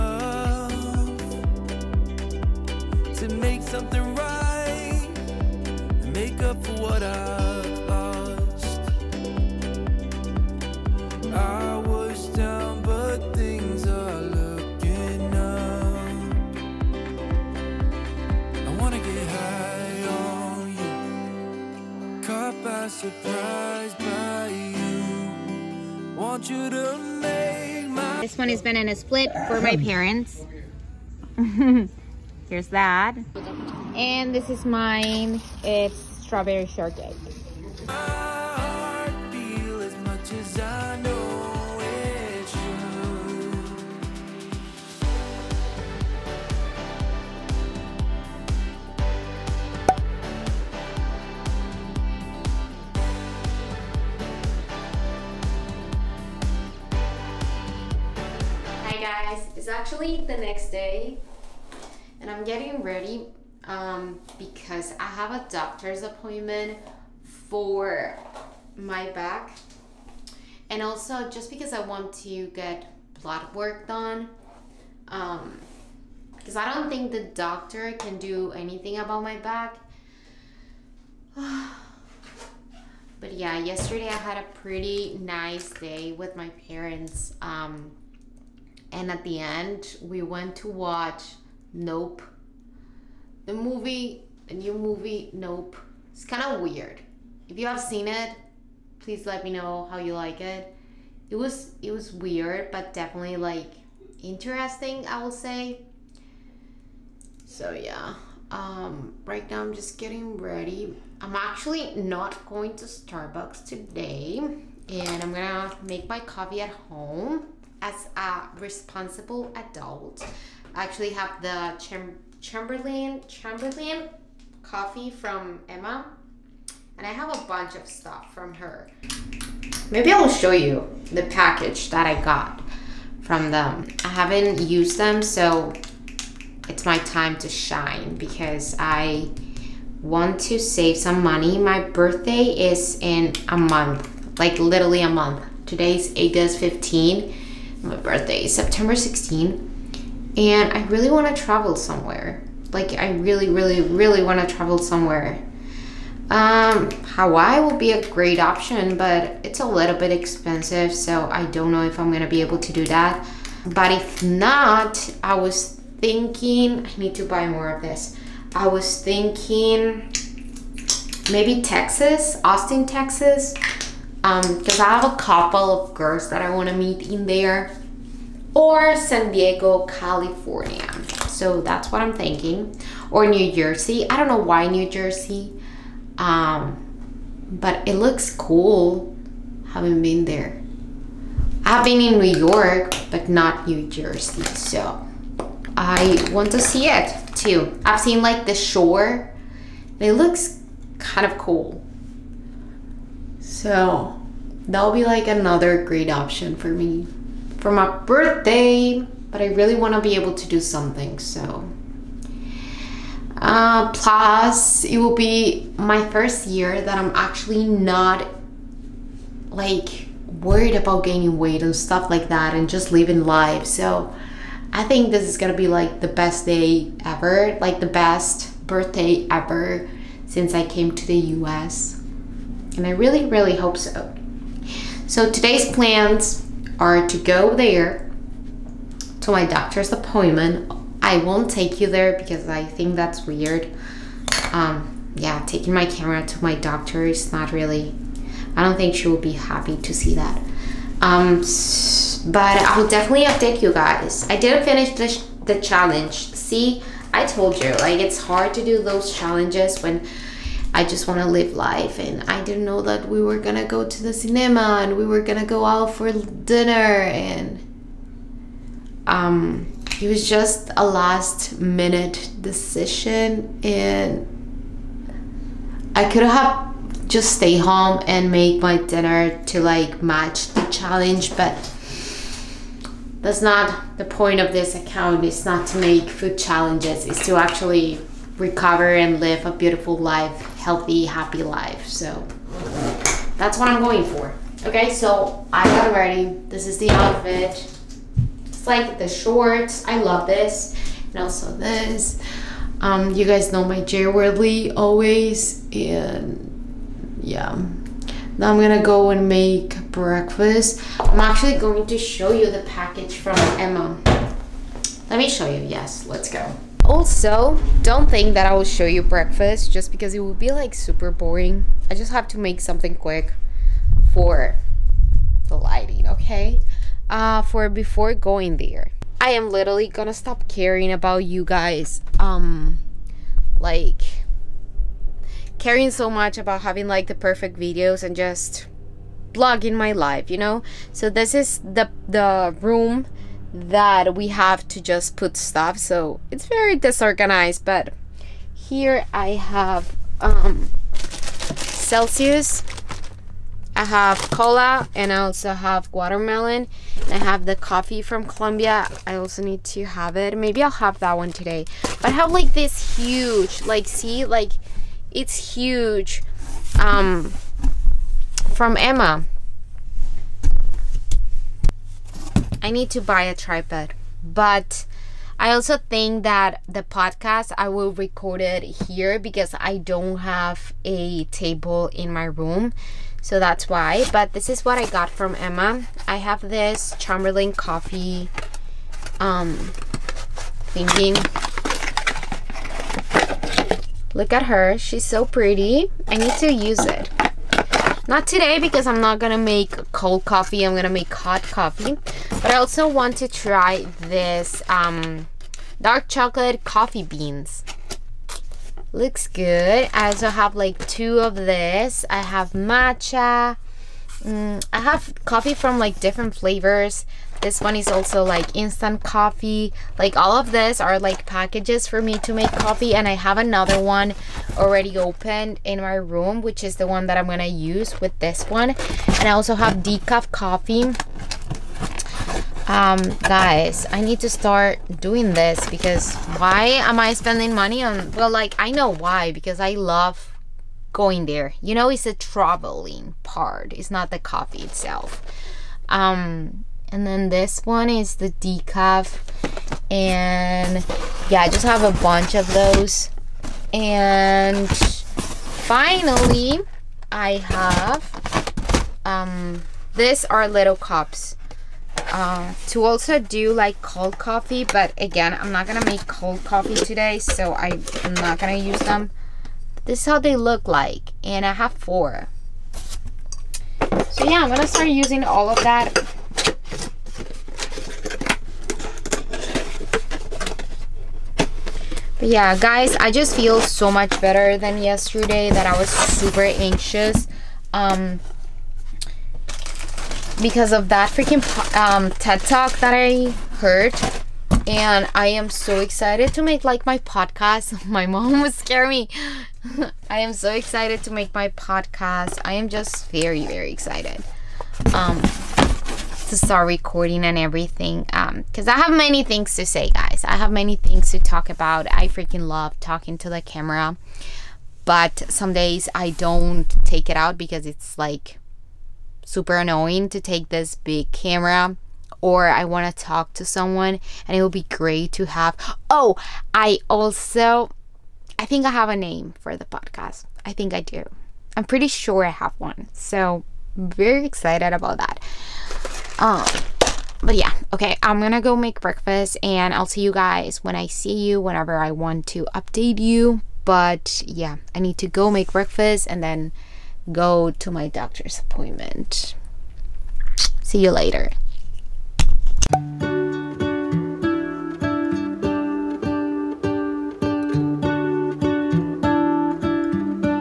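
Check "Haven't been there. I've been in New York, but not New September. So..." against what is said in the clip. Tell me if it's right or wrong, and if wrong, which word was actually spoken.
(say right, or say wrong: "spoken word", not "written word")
wrong: "Jersey", not "September".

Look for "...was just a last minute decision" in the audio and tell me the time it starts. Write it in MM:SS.
04:30.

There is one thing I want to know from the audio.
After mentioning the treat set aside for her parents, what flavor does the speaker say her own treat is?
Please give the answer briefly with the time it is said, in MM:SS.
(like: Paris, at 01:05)
Strawberry shortcake, at 00:35.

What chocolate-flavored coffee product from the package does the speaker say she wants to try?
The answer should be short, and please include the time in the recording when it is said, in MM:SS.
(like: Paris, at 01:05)
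dark chocolate coffee beans, at 06:45.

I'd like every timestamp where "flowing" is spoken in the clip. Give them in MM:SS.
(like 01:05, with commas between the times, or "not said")
not said.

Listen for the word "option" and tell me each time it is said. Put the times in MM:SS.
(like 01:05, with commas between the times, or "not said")
02:38, 03:26.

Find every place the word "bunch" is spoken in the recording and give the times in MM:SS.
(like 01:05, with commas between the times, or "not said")
02:07, 07:32.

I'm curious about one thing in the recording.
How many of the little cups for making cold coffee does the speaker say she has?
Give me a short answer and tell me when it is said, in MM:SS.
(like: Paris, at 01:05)
4, at 07:51.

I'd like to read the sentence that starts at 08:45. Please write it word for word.
Oh, I also I think I have a name for the podcast.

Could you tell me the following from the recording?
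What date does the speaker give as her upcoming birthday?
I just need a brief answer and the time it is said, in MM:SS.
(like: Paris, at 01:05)
September 16, at 02:28.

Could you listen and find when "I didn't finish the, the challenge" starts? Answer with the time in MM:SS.
04:14.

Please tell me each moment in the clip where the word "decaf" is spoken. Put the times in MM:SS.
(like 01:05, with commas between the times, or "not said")
07:09, 07:28.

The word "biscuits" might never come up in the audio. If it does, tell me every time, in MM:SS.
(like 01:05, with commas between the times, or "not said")
not said.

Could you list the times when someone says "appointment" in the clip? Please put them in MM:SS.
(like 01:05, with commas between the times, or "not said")
01:06, 03:59, 09:08.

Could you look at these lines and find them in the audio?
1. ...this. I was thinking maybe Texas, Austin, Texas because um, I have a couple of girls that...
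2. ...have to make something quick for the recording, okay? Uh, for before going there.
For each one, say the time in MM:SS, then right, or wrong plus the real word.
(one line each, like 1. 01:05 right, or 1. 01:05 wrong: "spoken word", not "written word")
1. 02:47 right
2. 05:22 wrong: "lighting", not "recording".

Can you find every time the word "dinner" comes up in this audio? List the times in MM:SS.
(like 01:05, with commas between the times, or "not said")
04:26, 04:38.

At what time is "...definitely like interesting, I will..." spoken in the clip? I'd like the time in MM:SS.
01:42.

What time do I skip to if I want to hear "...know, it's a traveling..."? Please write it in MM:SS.
07:21.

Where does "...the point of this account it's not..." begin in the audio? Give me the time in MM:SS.
04:43.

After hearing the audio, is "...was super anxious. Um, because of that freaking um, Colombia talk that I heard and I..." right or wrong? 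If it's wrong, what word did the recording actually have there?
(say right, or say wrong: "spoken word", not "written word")
wrong: "TED", not "Colombia".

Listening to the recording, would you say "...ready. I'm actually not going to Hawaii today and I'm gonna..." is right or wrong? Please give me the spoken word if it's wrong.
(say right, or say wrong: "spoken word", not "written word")
wrong: "Starbucks", not "Hawaii".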